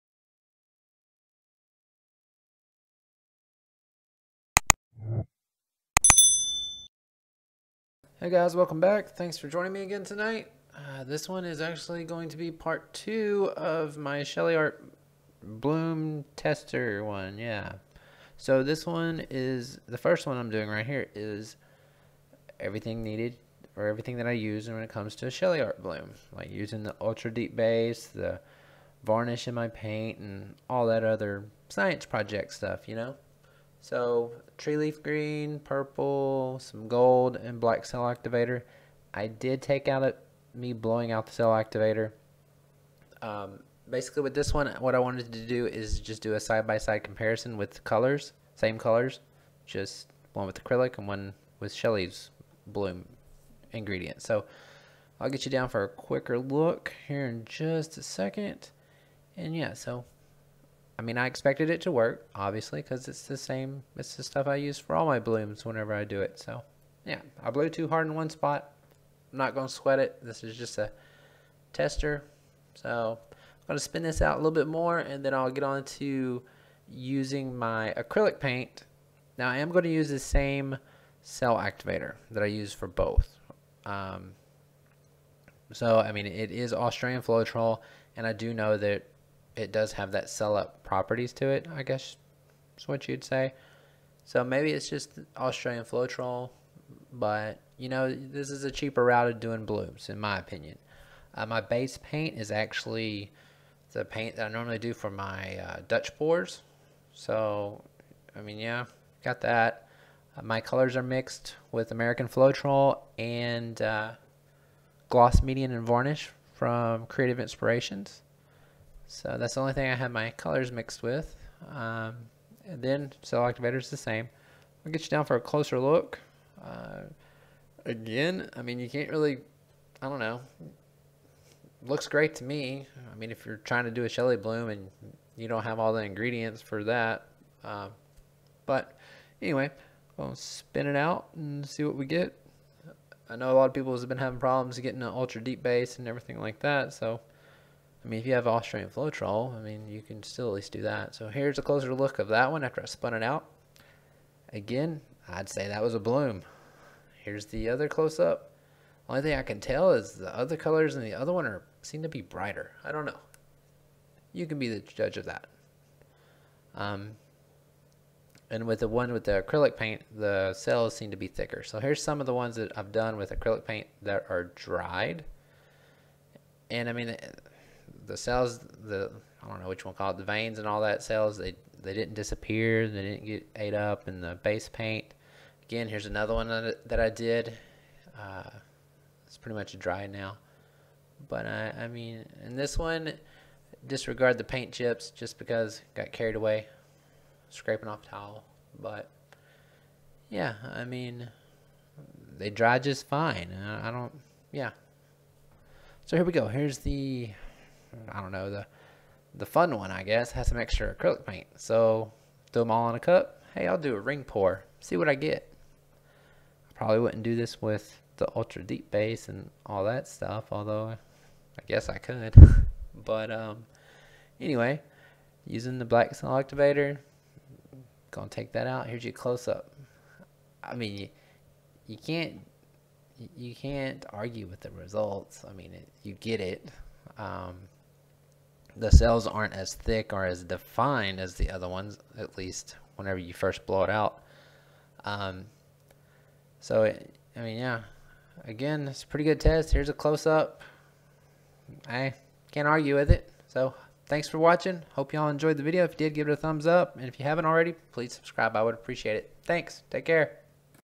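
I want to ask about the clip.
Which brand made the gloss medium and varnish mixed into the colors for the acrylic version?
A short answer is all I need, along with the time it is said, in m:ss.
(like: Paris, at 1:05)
Creative Inspirations, at 1:57.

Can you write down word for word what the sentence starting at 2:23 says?
I know a lot of people have been having problems getting an ultra deep base and everything like that.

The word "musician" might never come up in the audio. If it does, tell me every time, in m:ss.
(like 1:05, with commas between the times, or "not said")
not said.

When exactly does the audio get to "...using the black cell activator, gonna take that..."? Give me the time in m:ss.
3:45.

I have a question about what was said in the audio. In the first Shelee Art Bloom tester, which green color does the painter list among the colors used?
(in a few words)
Tree leaf green.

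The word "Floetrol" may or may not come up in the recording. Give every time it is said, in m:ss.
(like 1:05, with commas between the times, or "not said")
1:27, 1:35, 1:52, 2:28.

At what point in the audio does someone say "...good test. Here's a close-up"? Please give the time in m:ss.
4:09.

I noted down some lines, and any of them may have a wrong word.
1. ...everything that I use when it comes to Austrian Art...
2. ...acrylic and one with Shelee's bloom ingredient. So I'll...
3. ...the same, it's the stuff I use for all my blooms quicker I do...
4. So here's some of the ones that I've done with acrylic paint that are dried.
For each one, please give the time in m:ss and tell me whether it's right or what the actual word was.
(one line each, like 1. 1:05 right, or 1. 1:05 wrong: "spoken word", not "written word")
1. 0:23 wrong: "Shelee", not "Austrian"
2. 0:50 right
3. 1:03 wrong: "whenever", not "quicker"
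4. 2:51 right.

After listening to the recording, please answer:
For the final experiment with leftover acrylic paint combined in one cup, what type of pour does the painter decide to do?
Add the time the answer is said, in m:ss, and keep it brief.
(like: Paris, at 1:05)
Ring pour, at 3:33.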